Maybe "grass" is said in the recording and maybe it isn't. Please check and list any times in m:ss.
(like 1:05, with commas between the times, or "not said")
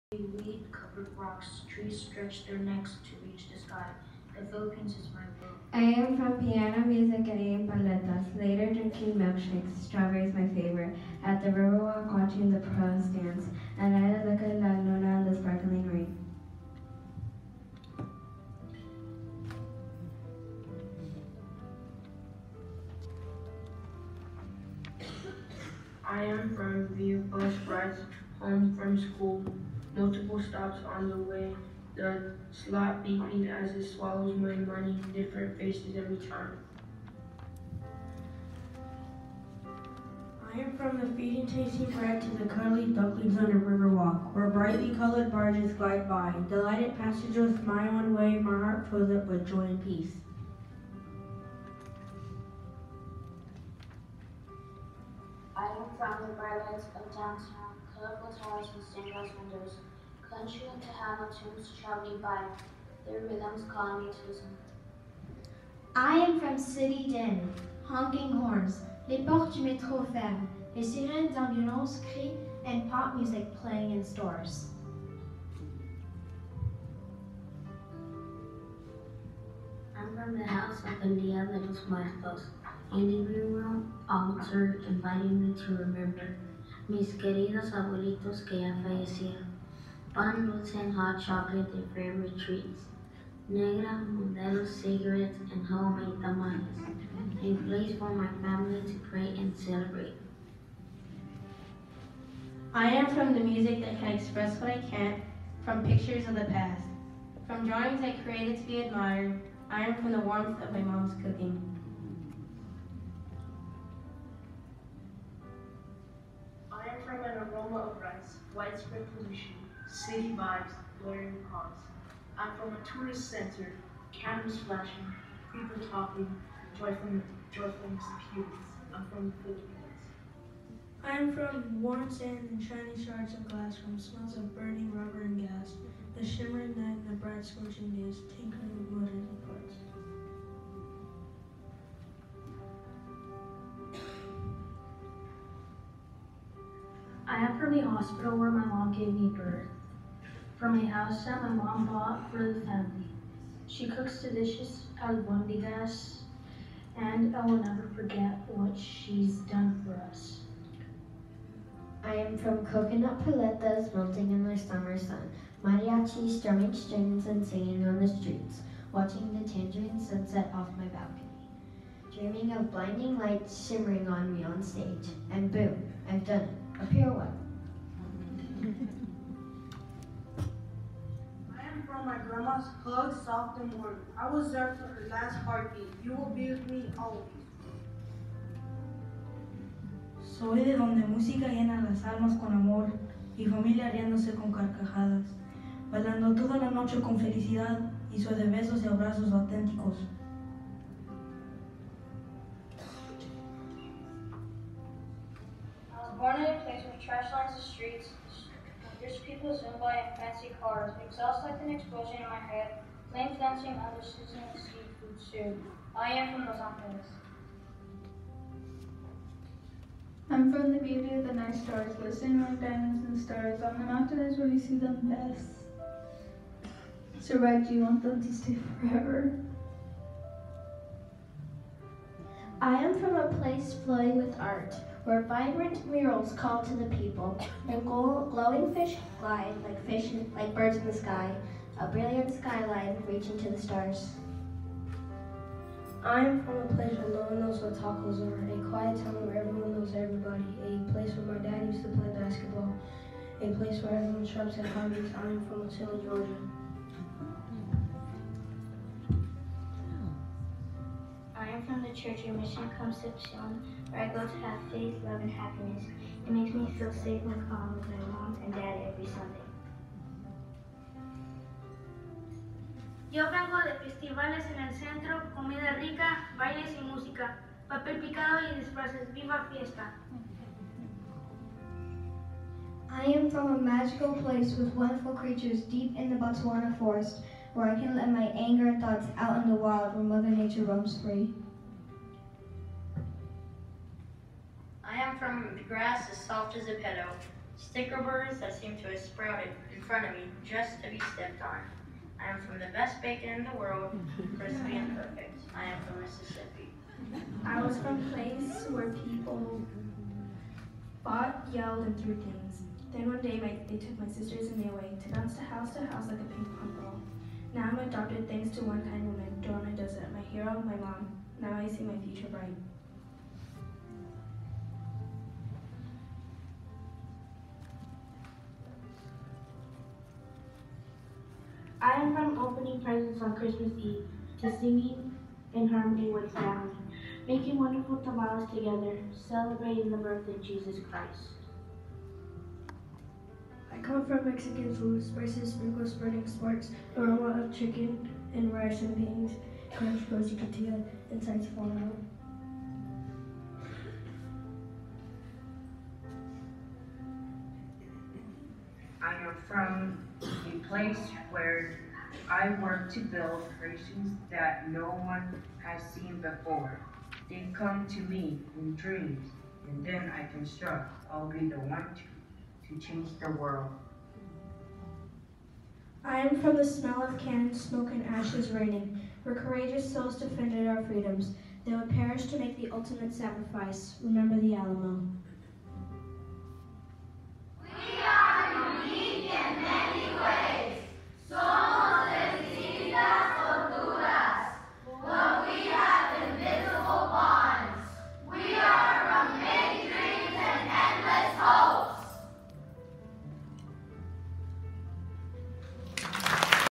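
4:55.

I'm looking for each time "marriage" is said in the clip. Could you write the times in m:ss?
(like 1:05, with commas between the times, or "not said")
not said.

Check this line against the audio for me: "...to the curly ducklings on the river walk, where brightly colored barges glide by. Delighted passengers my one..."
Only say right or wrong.
right.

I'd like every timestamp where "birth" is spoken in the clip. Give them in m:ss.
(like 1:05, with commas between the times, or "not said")
2:29, 5:39.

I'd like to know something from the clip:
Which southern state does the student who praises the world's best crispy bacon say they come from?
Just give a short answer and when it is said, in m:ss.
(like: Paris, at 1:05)
Mississippi, at 5:06.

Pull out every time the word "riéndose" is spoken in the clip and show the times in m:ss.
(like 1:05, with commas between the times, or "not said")
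3:13.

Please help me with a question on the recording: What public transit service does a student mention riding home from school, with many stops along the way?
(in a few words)
VIA.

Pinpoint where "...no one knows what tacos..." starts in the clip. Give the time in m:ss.
4:07.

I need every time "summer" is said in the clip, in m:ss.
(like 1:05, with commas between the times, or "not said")
2:44.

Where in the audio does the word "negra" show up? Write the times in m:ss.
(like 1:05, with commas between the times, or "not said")
1:33.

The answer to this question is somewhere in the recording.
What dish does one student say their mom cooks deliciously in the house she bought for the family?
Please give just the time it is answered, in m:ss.
2:35.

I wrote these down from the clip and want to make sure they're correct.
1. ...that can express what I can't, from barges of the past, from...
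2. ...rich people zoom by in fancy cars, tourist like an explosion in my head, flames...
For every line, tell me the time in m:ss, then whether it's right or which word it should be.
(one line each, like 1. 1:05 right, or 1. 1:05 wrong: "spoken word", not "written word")
1. 1:43 wrong: "pictures", not "barges"
2. 3:29 wrong: "exhaust", not "tourist".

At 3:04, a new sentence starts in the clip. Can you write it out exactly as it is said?
I was there for her last heartbeat.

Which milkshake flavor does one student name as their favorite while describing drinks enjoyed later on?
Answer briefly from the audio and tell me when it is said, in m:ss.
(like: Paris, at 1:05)
Strawberry, at 0:09.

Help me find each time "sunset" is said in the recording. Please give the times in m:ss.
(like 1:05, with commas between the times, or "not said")
2:49.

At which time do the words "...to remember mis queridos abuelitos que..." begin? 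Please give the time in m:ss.
1:25.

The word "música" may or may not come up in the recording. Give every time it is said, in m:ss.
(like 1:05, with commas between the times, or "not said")
3:11, 4:36.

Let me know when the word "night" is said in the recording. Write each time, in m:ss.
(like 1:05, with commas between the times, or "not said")
2:16, 3:41.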